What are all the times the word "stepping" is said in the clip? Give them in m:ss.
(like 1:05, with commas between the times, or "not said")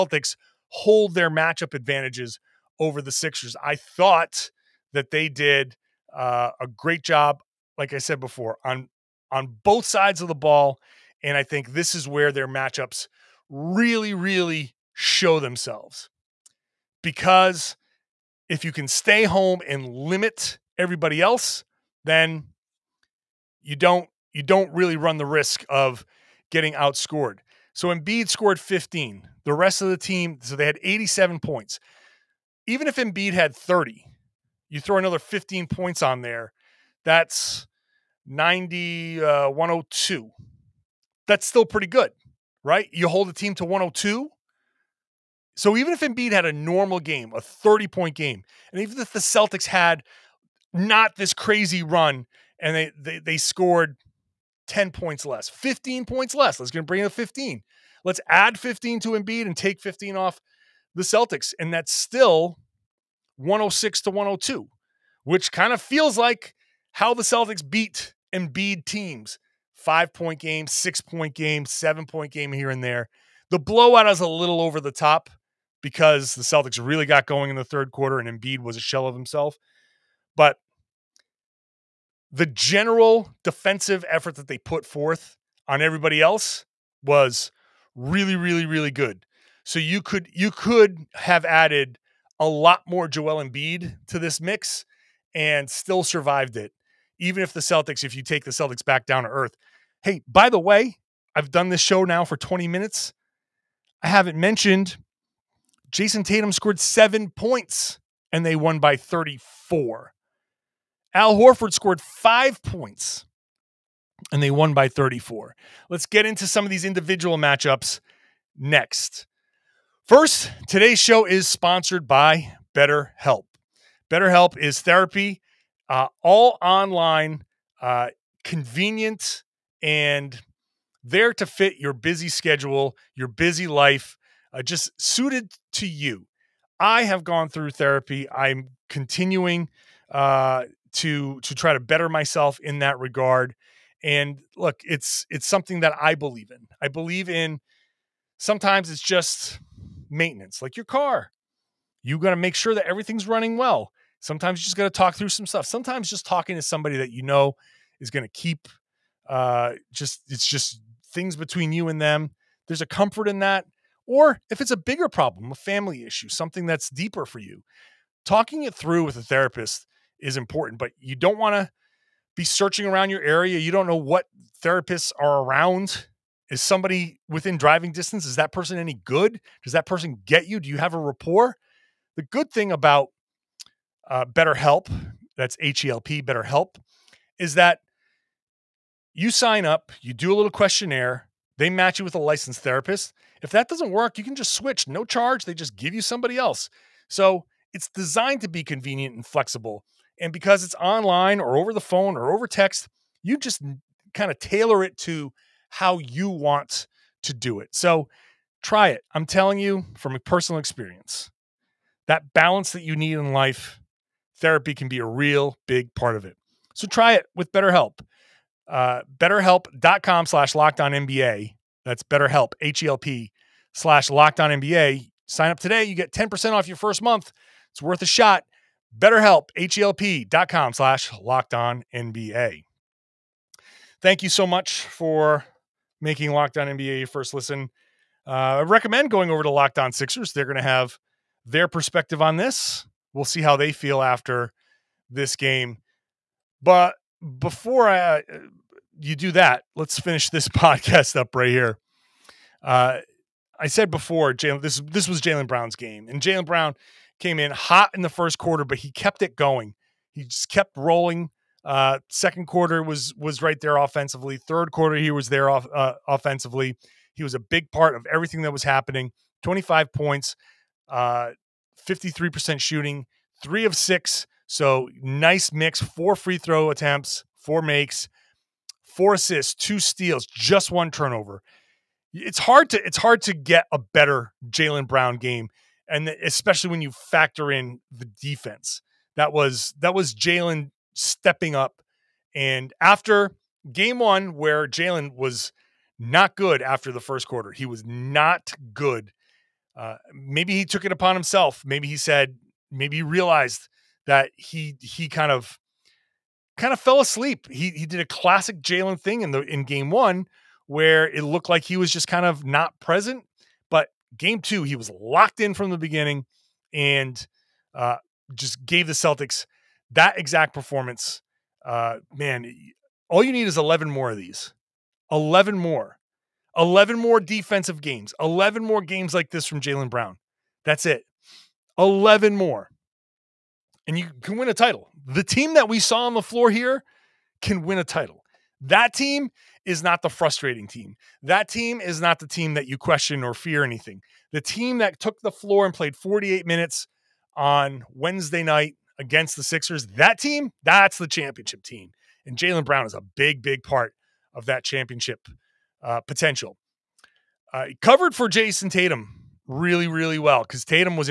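4:50.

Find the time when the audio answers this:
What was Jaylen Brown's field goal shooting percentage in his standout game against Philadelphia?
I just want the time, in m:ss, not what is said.
4:31.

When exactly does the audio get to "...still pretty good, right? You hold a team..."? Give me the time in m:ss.
0:41.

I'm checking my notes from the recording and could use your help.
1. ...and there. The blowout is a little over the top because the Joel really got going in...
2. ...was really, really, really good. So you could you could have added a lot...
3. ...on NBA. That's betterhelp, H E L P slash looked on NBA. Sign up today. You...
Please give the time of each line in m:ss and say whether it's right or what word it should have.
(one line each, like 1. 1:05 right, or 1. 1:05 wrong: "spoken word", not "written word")
1. 1:12 wrong: "Celtics", not "Joel"
2. 1:27 right
3. 3:40 wrong: "locked", not "looked".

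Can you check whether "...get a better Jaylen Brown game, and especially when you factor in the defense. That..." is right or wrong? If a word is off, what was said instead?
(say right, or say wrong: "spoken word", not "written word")
right.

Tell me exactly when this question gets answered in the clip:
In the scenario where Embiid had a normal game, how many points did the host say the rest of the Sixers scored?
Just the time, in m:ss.
0:30.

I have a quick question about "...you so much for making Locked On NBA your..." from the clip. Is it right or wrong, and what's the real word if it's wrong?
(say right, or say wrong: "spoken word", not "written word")
right.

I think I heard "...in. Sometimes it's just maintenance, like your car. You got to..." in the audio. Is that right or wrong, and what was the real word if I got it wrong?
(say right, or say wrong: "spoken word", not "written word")
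right.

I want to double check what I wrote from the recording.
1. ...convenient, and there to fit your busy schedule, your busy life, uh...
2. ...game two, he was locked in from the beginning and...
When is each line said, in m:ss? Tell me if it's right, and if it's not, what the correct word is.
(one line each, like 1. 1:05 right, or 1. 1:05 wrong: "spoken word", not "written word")
1. 2:08 right
2. 5:14 right.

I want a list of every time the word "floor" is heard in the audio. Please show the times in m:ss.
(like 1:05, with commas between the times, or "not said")
5:36, 5:45.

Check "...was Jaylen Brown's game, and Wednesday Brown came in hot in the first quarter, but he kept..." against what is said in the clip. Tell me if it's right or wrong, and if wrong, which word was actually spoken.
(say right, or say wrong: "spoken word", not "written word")
wrong: "Jaylen", not "Wednesday".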